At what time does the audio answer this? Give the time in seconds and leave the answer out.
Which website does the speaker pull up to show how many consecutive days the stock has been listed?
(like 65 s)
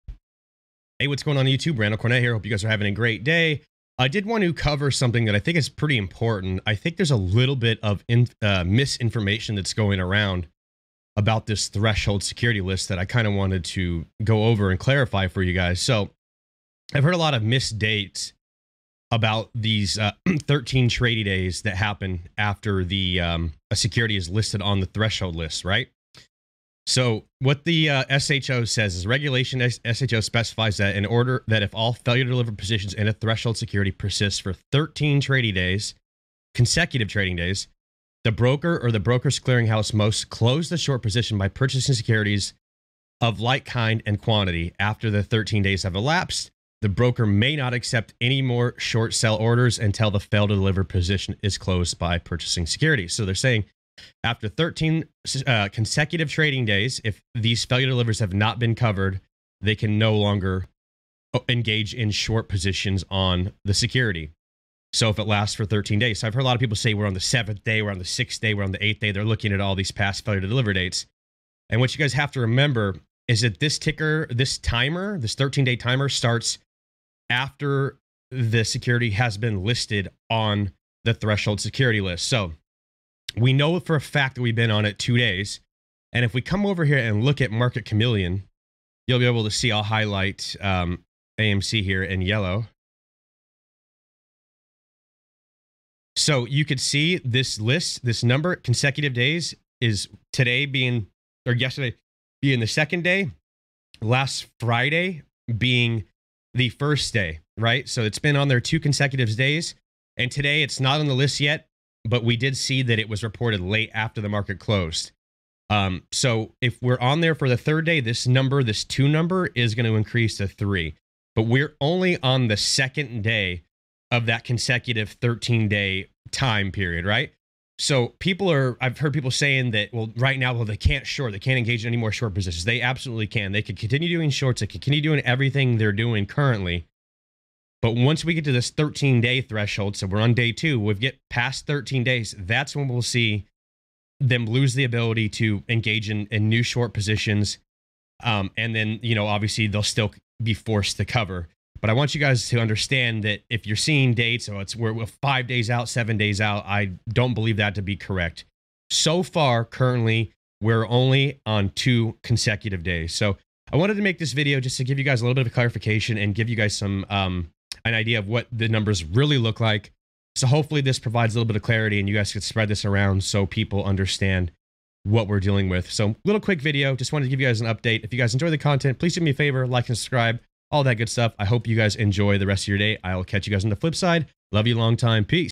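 87 s.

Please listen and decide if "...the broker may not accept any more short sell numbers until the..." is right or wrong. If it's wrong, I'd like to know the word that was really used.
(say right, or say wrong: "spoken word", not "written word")
wrong: "orders", not "numbers".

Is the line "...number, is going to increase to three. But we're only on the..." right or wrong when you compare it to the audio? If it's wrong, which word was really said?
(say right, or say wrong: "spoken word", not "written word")
right.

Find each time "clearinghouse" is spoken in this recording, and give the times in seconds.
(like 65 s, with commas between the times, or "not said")
39 s.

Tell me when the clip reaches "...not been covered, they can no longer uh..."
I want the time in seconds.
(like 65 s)
58 s.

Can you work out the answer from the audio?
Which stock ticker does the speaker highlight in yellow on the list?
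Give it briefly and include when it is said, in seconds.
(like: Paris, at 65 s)
AMC, at 91 s.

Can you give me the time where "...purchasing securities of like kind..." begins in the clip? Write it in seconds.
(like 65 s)
41 s.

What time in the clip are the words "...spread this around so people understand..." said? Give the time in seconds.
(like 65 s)
172 s.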